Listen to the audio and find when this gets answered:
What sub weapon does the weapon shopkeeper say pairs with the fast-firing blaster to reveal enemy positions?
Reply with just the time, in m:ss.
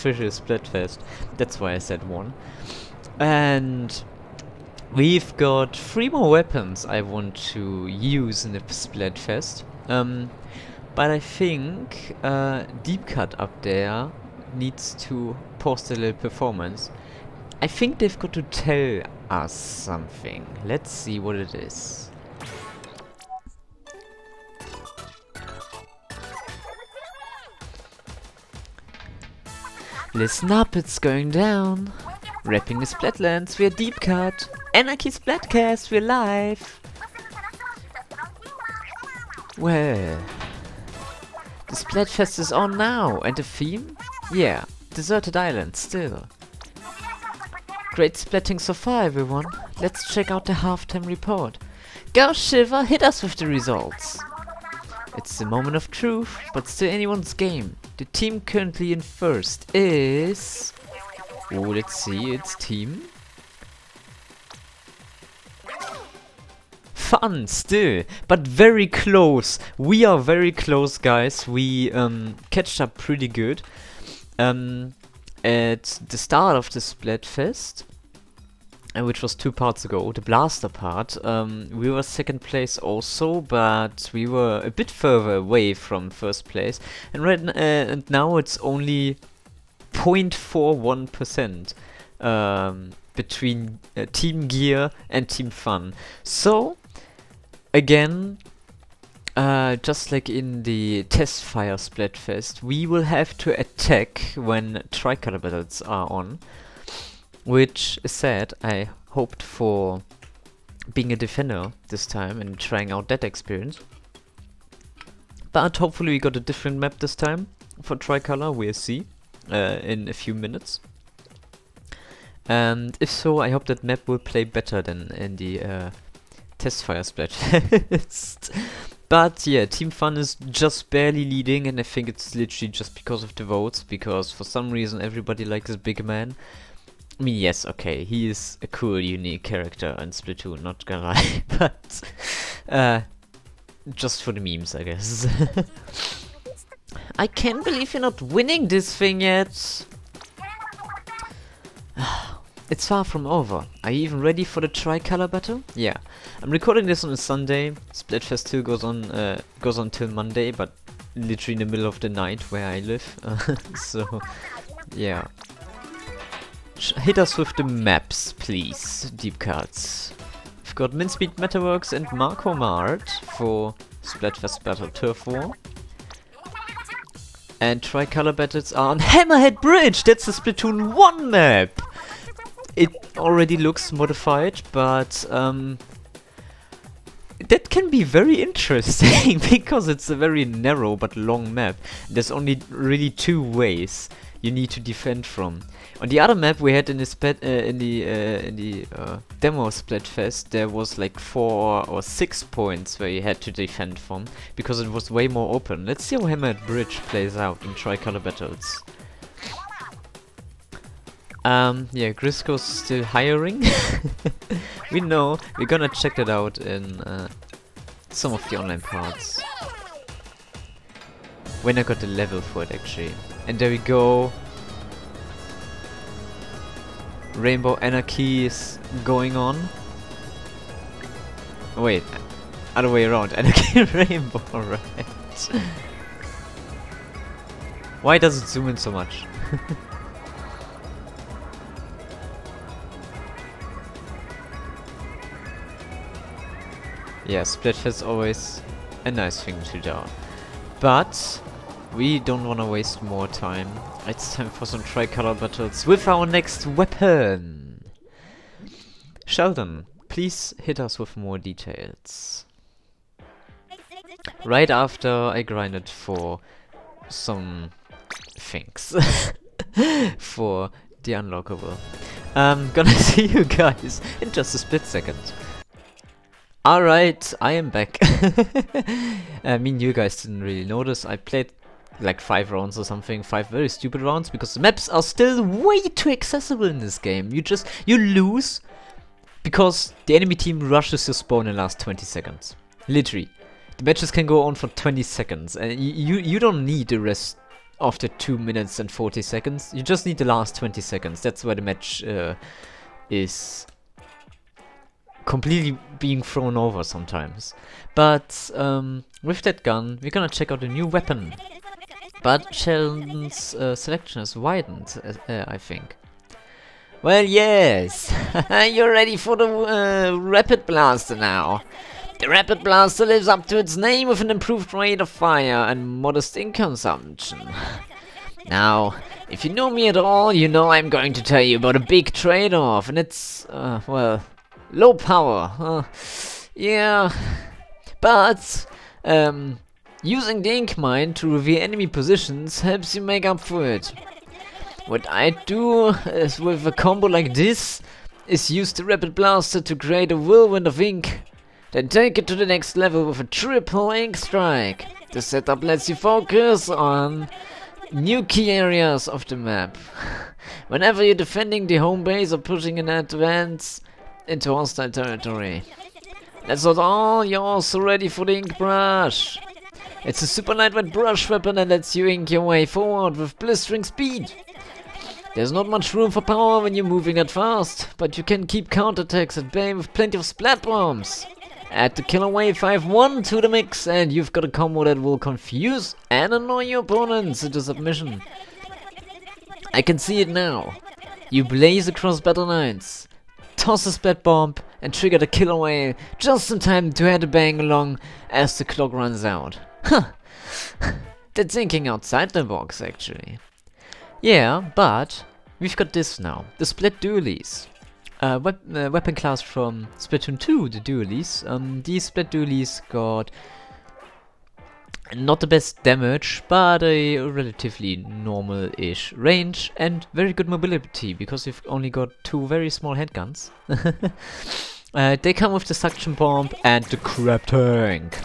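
5:40.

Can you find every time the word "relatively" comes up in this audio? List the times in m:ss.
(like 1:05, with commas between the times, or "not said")
6:57.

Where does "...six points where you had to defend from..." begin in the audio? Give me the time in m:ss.
3:22.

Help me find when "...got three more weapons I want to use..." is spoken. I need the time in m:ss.
0:05.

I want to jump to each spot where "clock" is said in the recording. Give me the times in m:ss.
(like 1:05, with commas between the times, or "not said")
6:38.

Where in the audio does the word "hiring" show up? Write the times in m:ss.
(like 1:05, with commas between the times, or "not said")
3:33.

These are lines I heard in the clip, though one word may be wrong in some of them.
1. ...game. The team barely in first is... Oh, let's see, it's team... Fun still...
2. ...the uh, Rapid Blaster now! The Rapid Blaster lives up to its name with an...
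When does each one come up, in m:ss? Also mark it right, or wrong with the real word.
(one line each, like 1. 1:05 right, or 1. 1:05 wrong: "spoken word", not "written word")
1. 0:57 wrong: "currently", not "barely"
2. 5:19 right.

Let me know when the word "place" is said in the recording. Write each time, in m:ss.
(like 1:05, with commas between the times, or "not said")
1:22, 1:26.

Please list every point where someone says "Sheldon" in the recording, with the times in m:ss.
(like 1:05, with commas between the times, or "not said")
4:19, 5:12.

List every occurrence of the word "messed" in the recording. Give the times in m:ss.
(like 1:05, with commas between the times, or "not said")
not said.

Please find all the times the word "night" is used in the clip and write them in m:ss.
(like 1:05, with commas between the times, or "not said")
2:42.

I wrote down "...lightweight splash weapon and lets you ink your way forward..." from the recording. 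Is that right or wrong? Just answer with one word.
wrong.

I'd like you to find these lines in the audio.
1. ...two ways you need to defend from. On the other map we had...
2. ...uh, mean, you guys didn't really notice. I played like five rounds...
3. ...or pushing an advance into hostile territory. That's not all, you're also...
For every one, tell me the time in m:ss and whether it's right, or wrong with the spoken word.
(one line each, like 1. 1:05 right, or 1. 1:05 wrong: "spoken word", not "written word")
1. 3:13 right
2. 4:39 right
3. 6:02 right.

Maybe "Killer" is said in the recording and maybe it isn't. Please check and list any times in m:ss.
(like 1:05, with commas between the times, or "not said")
6:22, 6:35.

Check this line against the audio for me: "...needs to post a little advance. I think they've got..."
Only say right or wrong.
wrong.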